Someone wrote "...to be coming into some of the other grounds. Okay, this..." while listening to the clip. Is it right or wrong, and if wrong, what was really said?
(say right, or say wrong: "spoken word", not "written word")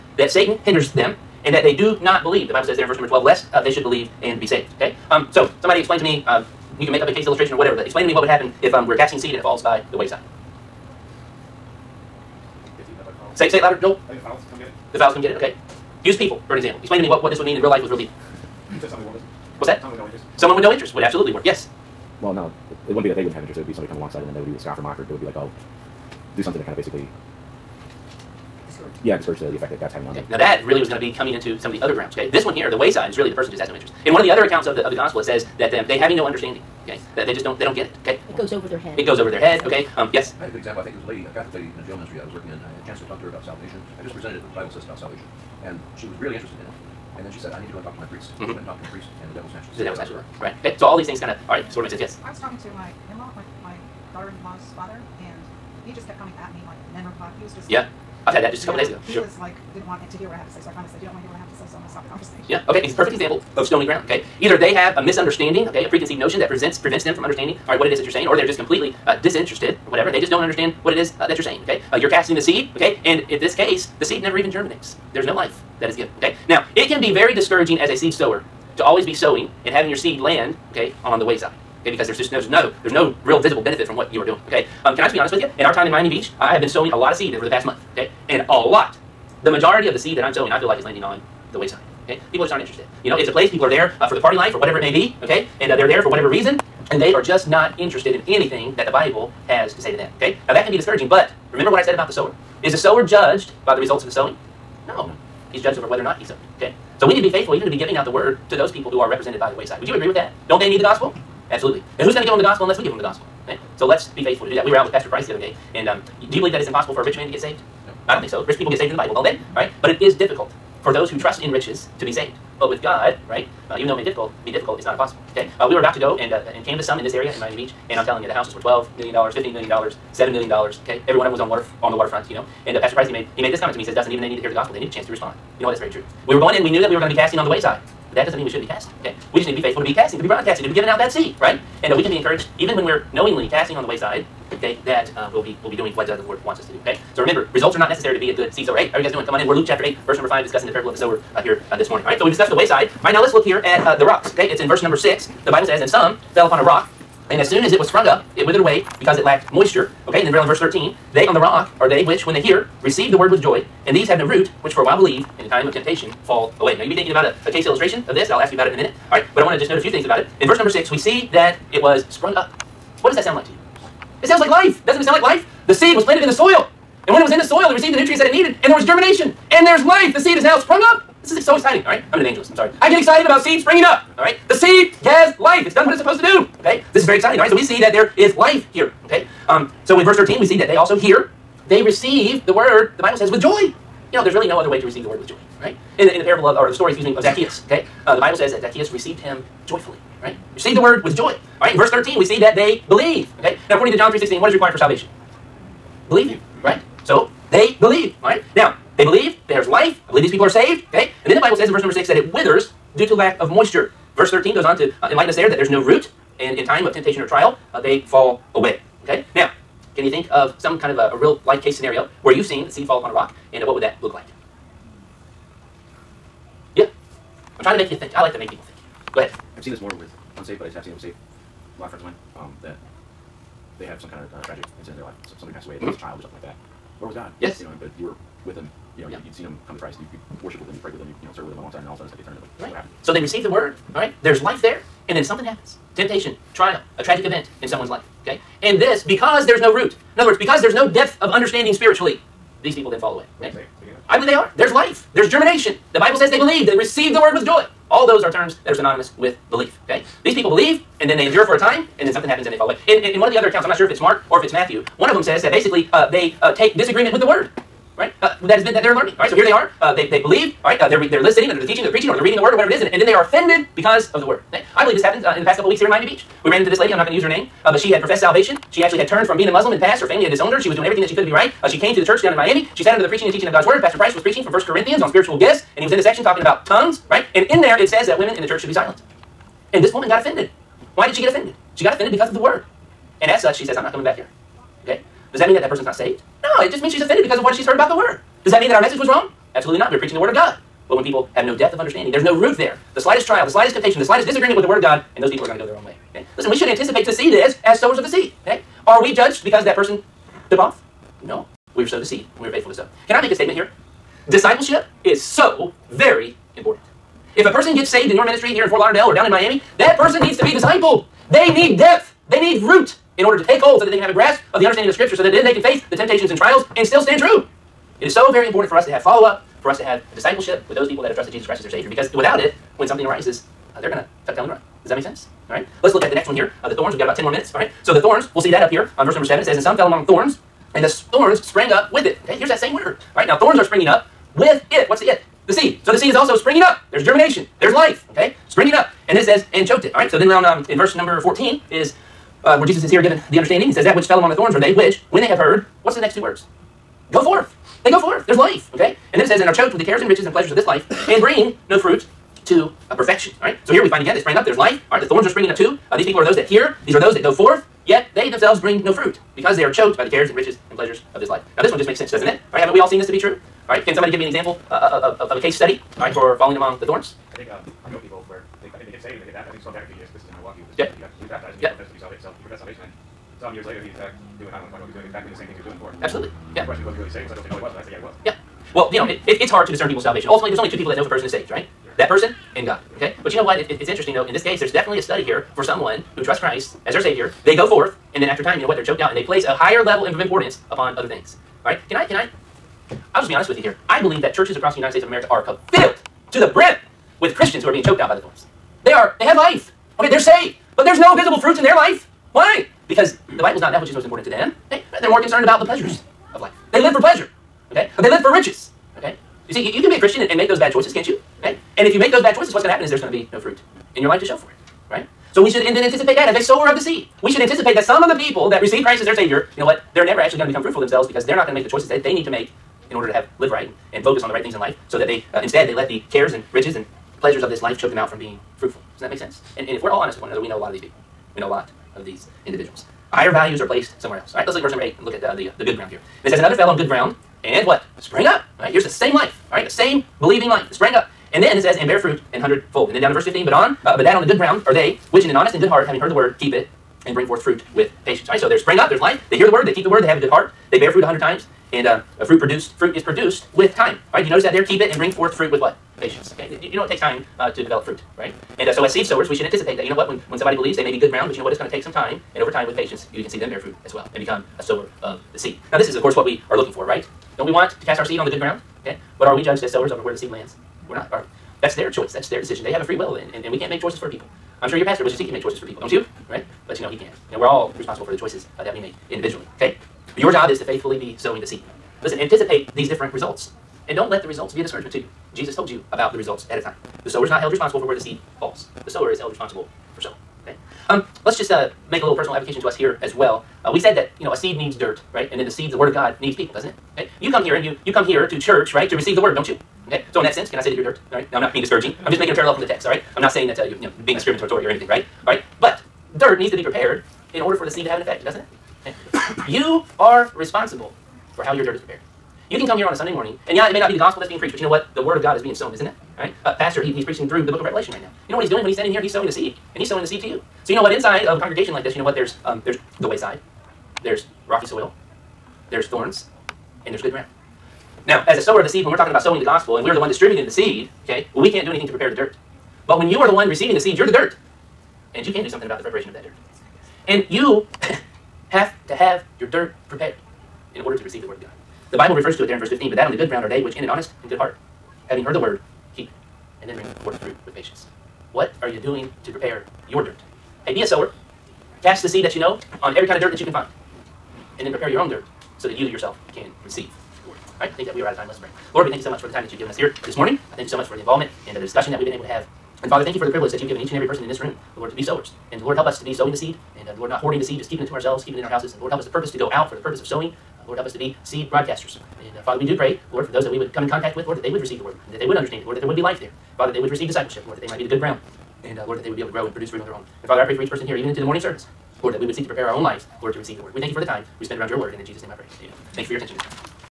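right.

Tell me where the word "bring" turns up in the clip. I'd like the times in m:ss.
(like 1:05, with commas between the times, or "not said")
6:01, 6:08, 7:37, 7:44, 9:16.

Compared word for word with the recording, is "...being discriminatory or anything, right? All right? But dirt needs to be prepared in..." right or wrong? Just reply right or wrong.
right.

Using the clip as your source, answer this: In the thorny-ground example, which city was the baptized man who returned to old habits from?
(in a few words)
Milwaukee.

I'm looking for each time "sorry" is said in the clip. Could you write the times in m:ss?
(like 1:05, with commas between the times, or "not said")
3:02.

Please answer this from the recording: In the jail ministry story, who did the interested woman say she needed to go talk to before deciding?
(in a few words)
Her priest.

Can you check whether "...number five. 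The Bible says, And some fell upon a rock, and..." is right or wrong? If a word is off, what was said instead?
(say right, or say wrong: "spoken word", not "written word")
wrong: "six", not "five".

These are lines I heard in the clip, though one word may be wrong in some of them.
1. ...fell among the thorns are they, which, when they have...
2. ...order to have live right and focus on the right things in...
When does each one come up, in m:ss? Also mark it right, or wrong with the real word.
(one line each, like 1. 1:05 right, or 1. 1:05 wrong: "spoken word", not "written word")
1. 5:54 right
2. 7:12 right.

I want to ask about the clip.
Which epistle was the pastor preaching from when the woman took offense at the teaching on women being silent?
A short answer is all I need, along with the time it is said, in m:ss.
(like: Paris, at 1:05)
1 Corinthians, at 4:44.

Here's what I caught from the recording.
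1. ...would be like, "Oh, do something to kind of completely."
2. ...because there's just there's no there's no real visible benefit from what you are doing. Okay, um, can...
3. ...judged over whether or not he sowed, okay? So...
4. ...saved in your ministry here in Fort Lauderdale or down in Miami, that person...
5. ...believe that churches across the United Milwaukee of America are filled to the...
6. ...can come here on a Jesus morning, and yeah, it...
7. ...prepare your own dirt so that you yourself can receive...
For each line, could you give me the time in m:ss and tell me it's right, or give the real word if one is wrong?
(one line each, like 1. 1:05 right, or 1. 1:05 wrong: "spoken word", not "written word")
1. 0:25 wrong: "basically", not "completely"
2. 1:21 right
3. 1:45 right
4. 5:17 right
5. 6:44 wrong: "States", not "Milwaukee"
6. 8:42 wrong: "Sunday", not "Jesus"
7. 9:24 right.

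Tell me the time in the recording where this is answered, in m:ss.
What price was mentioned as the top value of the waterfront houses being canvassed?
2:09.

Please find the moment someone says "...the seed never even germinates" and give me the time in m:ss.
1:14.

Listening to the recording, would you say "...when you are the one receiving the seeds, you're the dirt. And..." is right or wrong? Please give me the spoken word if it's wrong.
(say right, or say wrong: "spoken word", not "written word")
right.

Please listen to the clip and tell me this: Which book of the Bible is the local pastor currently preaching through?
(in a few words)
Revelation.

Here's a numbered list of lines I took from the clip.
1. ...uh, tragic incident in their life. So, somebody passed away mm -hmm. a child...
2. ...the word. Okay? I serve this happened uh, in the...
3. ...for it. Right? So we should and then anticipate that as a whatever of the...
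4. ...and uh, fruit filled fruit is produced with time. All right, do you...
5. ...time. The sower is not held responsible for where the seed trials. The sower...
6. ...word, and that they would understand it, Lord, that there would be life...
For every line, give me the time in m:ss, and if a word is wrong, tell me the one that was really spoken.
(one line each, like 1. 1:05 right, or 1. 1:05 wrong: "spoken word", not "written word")
1. 3:54 right
2. 4:34 wrong: "believe", not "serve"
3. 7:04 wrong: "sower", not "whatever"
4. 7:41 wrong: "produced", not "filled"
5. 8:16 wrong: "falls", not "trials"
6. 9:44 right.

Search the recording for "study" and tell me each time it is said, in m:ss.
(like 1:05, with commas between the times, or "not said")
6:15, 6:35.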